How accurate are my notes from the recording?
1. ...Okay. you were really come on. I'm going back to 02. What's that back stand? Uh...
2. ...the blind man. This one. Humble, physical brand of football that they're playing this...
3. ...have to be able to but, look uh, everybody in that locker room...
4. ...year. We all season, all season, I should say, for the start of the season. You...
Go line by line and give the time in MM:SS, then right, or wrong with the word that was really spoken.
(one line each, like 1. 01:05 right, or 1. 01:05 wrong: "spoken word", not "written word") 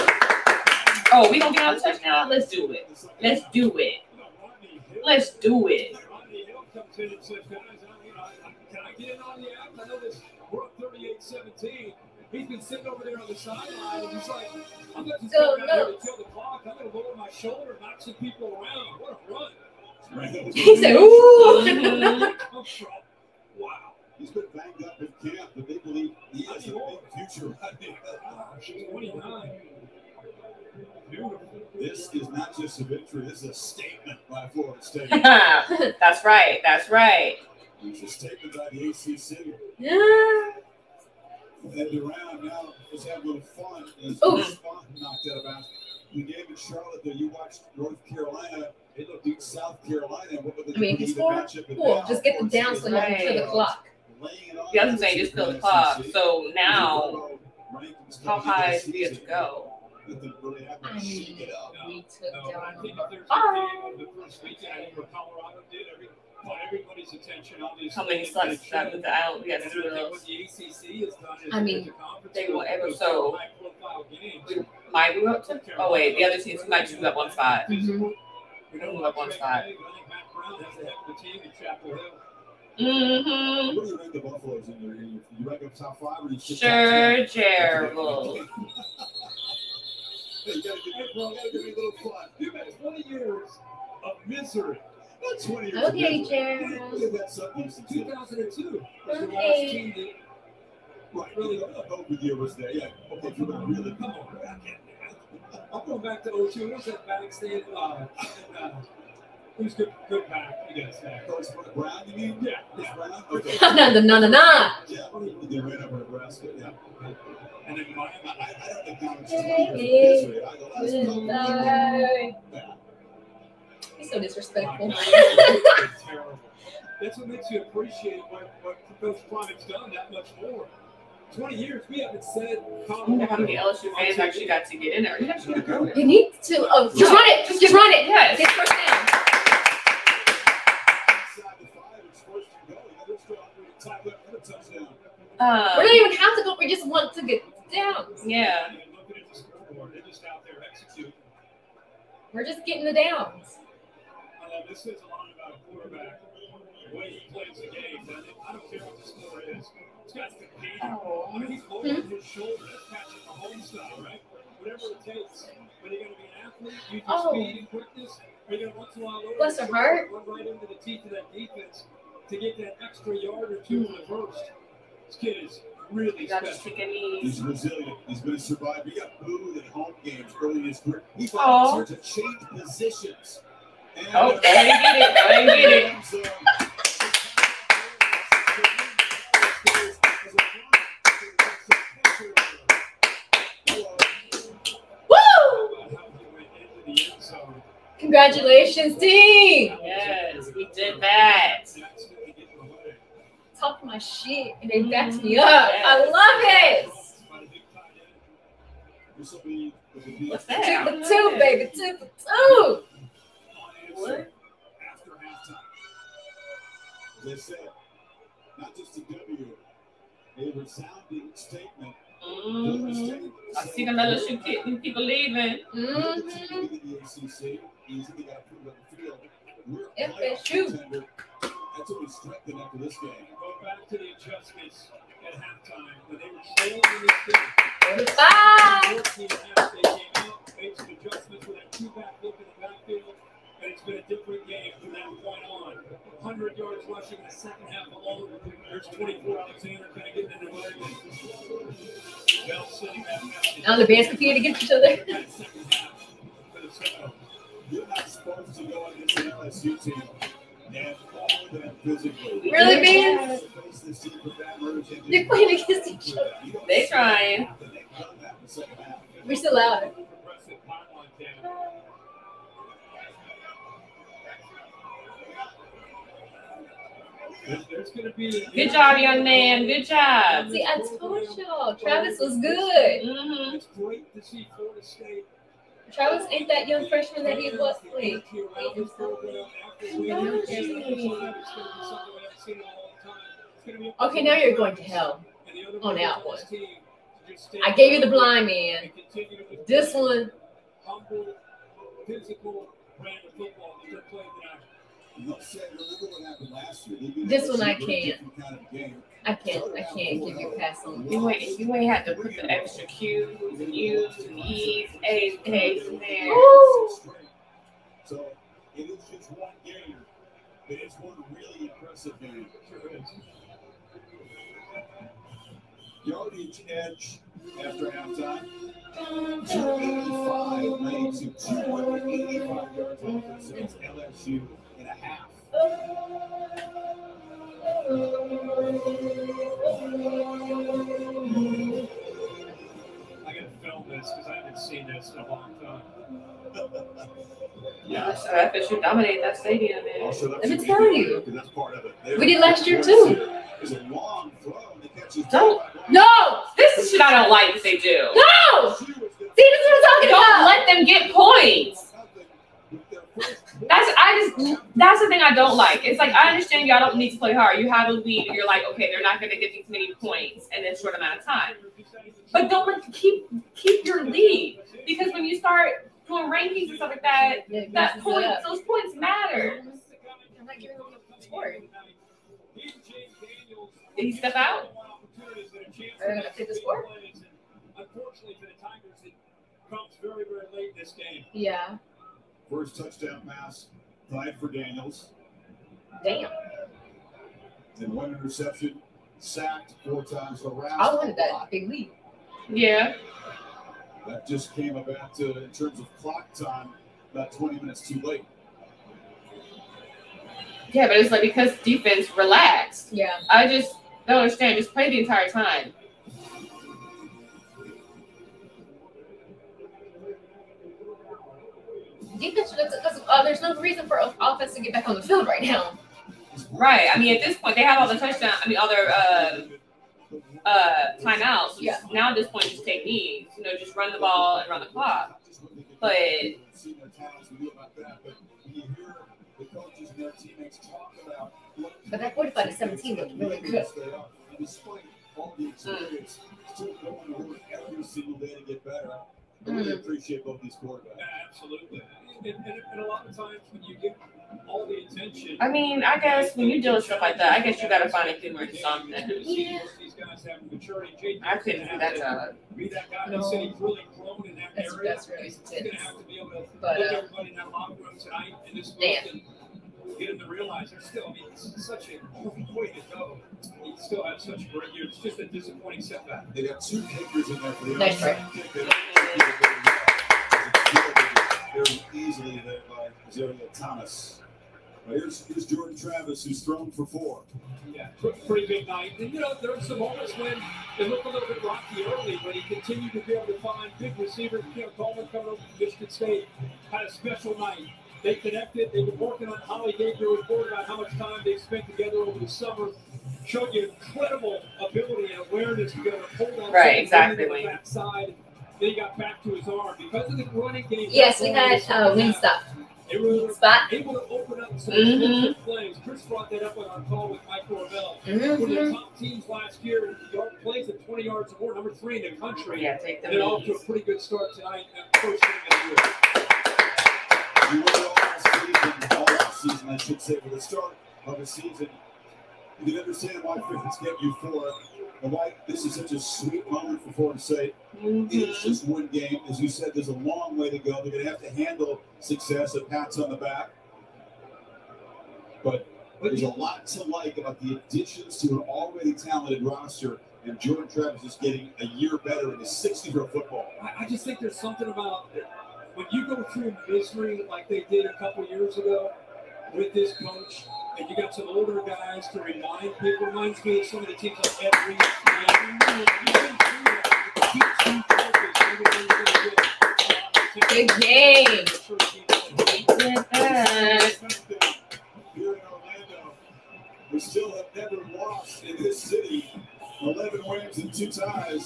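1. 01:43 right
2. 04:58 right
3. 07:45 right
4. 08:46 right.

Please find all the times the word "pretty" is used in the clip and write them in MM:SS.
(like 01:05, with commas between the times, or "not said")
08:08, 08:43.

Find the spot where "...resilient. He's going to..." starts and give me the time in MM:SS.
02:57.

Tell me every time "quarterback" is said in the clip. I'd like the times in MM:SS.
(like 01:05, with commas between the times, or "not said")
02:35, 07:30.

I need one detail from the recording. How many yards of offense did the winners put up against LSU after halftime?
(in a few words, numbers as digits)
285 yards.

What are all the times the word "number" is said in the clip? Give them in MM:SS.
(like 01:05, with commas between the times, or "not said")
08:41.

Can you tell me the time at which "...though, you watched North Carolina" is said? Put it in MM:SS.
00:47.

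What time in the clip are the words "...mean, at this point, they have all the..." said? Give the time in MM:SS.
07:06.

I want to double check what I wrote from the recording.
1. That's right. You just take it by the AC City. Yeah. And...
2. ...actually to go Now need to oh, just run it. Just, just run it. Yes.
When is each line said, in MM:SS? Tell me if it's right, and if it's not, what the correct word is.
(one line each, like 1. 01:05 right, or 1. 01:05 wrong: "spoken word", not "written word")
1. 00:36 right
2. 02:15 wrong: "You", not "Now".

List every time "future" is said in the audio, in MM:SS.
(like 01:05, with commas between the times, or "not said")
00:27.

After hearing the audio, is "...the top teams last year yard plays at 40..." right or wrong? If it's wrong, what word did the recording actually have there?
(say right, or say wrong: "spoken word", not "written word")
wrong: "20", not "40".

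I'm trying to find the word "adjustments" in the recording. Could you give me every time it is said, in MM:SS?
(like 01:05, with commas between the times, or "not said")
03:54, 04:00.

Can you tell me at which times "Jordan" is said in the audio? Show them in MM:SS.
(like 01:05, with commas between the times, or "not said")
08:05, 09:10.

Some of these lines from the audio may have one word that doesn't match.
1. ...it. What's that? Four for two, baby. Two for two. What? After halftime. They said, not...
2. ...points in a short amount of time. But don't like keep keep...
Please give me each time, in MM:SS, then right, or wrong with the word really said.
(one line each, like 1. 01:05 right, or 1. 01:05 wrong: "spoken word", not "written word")
1. 03:29 wrong: "Two", not "Four"
2. 06:09 right.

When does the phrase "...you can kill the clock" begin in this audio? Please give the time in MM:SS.
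00:52.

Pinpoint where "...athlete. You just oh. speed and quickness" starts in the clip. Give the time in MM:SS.
02:46.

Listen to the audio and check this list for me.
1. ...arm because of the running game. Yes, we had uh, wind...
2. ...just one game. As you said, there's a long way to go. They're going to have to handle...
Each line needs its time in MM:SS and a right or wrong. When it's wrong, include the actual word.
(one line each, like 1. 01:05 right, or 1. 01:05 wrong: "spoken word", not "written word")
1. 08:29 right
2. 08:58 right.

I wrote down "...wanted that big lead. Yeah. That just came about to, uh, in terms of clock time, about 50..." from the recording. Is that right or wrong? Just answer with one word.
wrong.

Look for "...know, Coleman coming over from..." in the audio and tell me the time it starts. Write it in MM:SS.
08:14.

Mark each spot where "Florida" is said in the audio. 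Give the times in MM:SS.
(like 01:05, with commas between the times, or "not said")
00:34, 08:56.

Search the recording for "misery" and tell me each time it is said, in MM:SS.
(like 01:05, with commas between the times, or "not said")
01:34, 09:16.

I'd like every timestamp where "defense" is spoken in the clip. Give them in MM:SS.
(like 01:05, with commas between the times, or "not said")
02:51, 06:51, 07:02.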